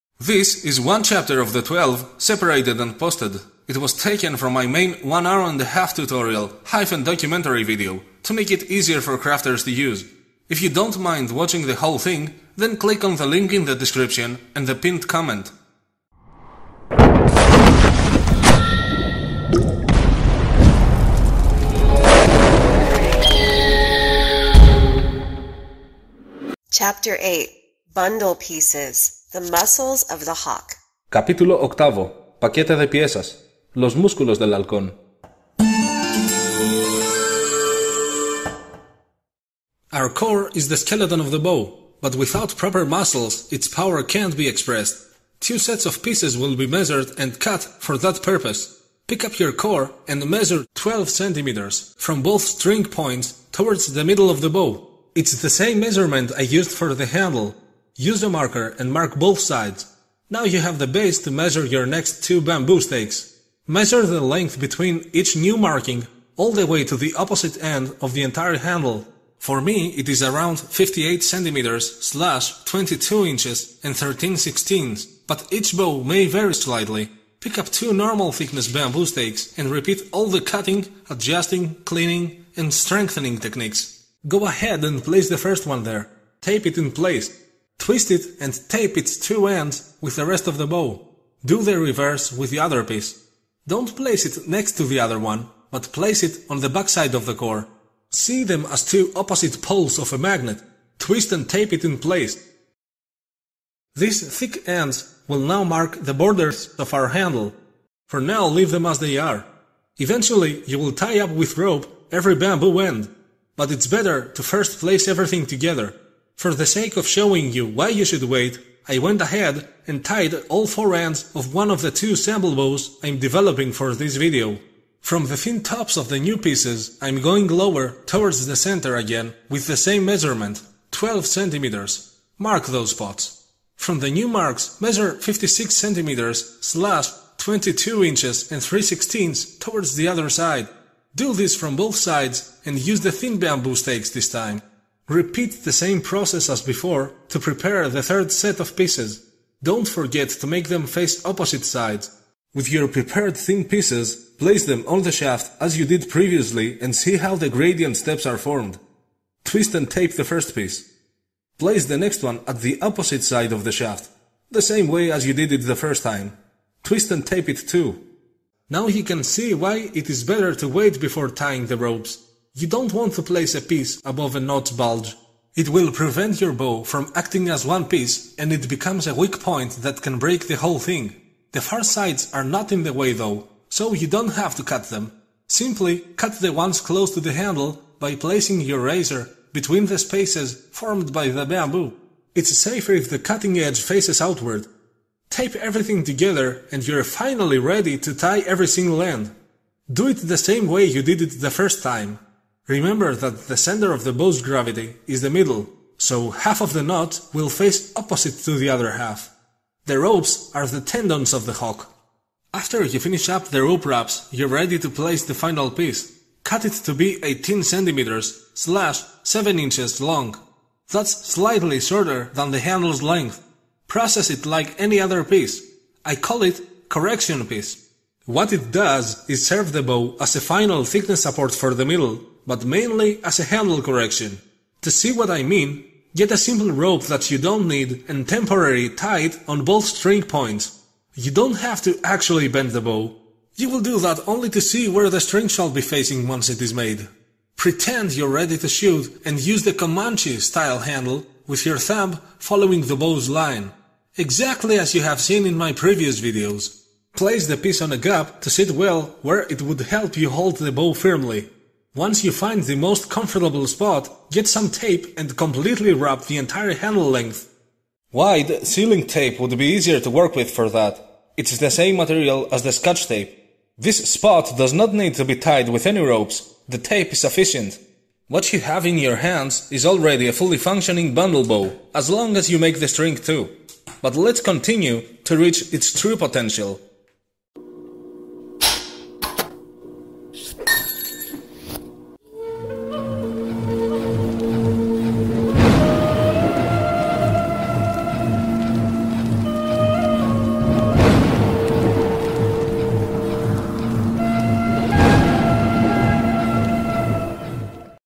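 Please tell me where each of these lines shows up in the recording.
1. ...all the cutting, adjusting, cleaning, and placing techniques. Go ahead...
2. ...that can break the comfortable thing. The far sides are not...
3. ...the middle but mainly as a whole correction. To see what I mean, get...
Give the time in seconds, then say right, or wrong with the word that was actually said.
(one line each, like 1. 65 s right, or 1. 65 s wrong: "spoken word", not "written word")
1. 80 s wrong: "strengthening", not "placing"
2. 179 s wrong: "whole", not "comfortable"
3. 231 s wrong: "handle", not "whole".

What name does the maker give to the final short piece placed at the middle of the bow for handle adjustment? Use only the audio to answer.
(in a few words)
correction piece.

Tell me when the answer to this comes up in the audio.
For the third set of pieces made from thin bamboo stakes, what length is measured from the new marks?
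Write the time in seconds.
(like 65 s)
135 s.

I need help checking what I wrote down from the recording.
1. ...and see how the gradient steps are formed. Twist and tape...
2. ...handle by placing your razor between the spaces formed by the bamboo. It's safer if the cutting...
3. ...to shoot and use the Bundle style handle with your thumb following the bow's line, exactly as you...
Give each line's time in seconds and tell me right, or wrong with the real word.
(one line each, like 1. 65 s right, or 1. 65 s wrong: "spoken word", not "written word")
1. 156 s right
2. 187 s right
3. 248 s wrong: "Comanche", not "Bundle".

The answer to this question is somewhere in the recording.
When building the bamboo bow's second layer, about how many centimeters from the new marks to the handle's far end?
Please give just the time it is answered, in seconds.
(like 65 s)
70 s.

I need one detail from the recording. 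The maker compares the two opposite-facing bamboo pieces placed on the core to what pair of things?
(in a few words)
two opposite poles of a magnet.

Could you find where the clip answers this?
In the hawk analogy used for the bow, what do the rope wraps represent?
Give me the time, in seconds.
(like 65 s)
210 s.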